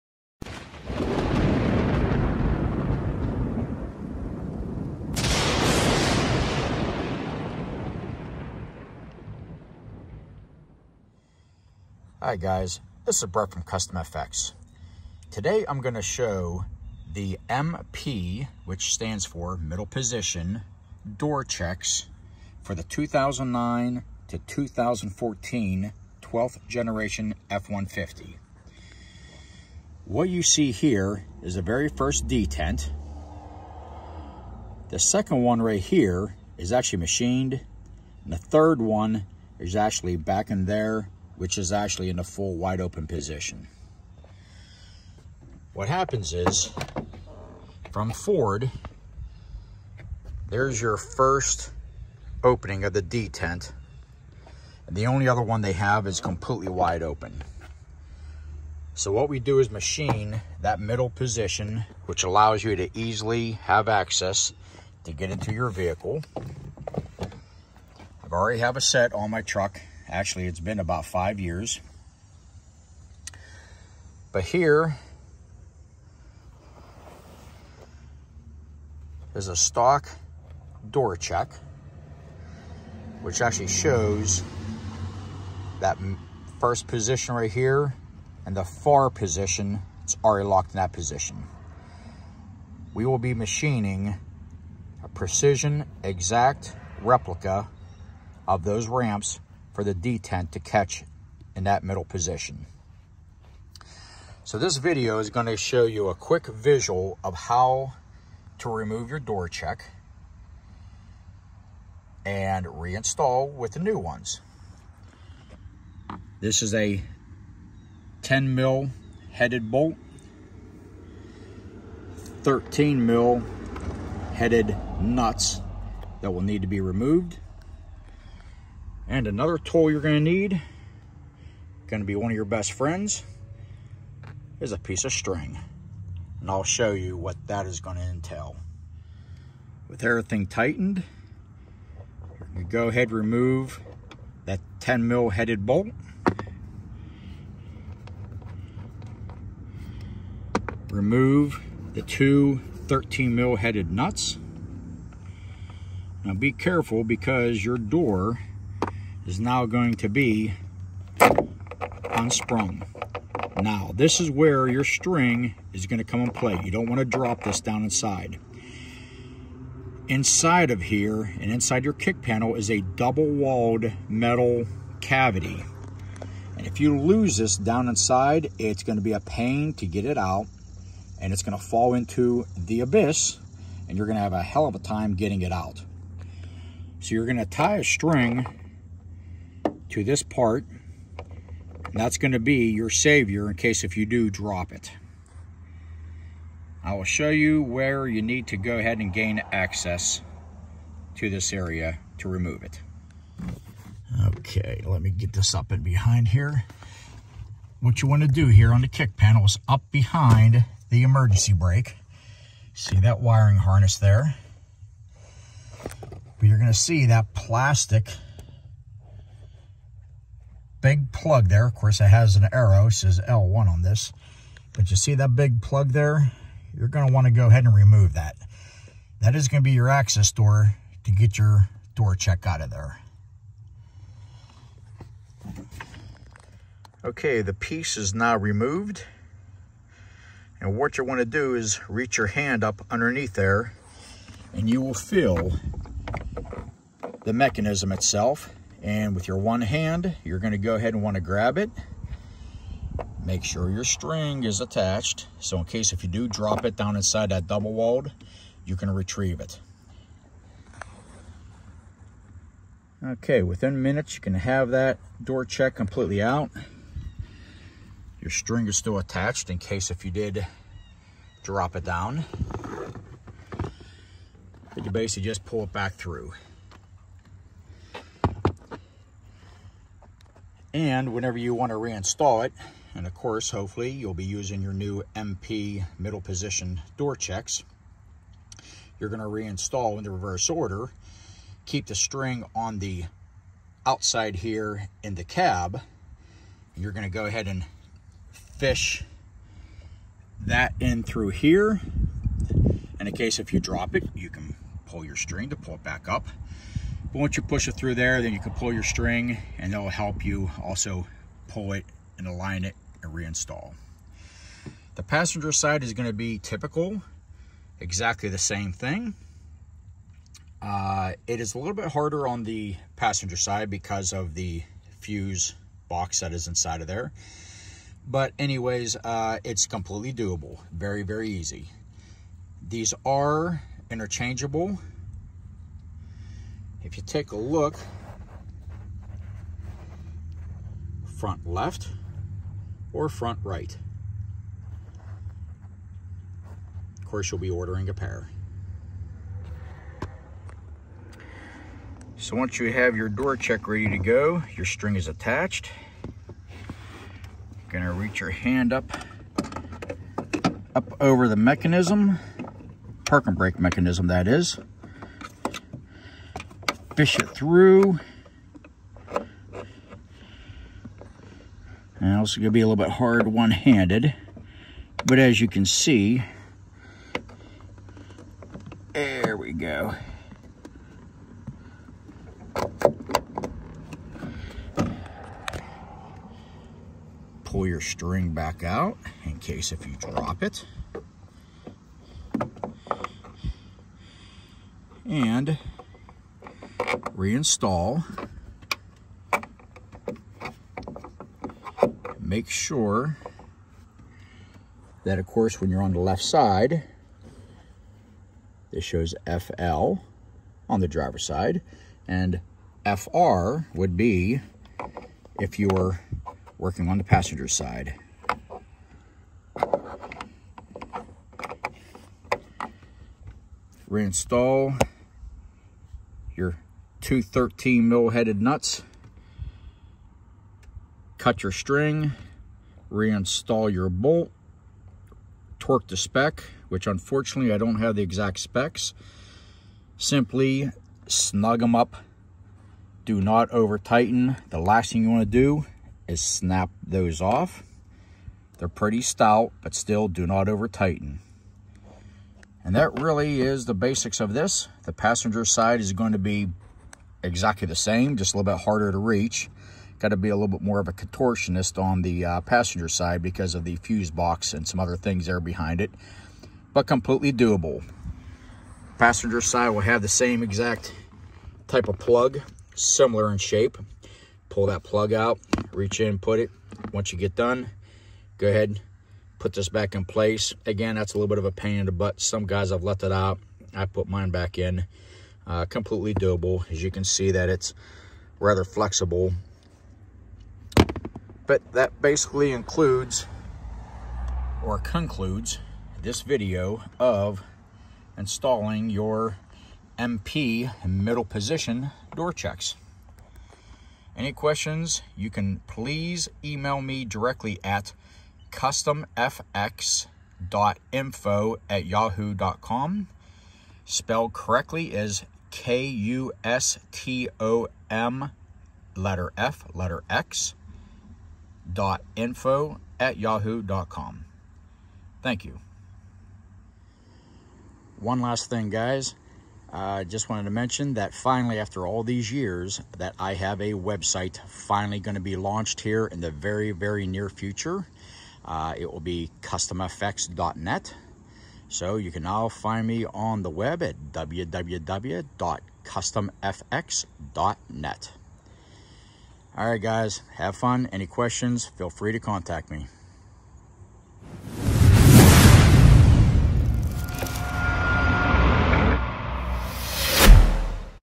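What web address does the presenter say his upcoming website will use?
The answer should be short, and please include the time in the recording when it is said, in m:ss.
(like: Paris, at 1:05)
kustomfx.net, at 8:59.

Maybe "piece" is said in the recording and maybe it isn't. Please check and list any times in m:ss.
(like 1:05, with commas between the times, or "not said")
2:14, 3:57.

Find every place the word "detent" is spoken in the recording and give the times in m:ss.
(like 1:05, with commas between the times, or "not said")
0:32, 0:53, 1:39.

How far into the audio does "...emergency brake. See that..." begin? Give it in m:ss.
3:31.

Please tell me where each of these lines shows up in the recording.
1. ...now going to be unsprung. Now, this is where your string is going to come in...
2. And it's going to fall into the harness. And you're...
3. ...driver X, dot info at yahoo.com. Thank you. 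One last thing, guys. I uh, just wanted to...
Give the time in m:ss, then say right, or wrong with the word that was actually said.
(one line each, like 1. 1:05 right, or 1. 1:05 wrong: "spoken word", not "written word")
1. 2:39 right
2. 3:01 wrong: "abyss", not "harness"
3. 8:39 wrong: "letter", not "driver".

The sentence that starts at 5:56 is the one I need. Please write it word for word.
You're gonna reach your hand up, up over the mechanism, park and brake mechanism that is fish it through.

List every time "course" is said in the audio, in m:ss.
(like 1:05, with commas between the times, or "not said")
3:41, 4:43, 5:47, 6:45.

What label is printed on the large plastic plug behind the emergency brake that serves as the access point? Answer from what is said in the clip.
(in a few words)
L1.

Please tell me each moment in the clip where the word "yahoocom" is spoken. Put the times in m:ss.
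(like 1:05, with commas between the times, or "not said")
8:31, 8:43.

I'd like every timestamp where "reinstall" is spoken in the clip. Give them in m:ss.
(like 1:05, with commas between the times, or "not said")
1:52, 4:41, 4:49, 5:13, 6:37, 7:03, 7:12.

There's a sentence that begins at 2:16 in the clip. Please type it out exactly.
And I'll show you what that is gonna entail.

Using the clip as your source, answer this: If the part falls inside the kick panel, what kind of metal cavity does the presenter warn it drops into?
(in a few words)
double-walled.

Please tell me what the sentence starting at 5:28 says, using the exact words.
But anyways, uh, it's completely doable.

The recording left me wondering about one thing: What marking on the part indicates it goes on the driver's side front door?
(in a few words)
FL.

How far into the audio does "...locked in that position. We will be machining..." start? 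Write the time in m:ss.
1:30.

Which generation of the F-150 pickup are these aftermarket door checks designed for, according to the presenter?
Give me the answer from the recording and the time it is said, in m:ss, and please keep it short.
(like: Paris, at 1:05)
12th generation, at 0:26.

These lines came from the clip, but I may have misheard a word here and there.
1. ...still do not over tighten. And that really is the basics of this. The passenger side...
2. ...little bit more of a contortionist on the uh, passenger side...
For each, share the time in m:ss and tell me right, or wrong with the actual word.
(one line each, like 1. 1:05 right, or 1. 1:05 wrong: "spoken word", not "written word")
1. 7:29 right
2. 7:40 right.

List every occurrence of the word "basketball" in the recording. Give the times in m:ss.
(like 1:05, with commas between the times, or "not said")
not said.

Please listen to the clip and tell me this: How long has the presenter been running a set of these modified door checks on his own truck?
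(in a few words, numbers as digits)
about 5 years.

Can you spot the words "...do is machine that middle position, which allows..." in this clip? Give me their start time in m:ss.
0:59.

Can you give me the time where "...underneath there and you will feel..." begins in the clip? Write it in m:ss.
4:02.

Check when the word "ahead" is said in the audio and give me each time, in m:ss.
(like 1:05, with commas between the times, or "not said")
2:22, 3:18, 3:47, 4:10, 4:57, 7:58.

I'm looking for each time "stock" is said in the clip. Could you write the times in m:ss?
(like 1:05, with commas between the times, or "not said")
1:19.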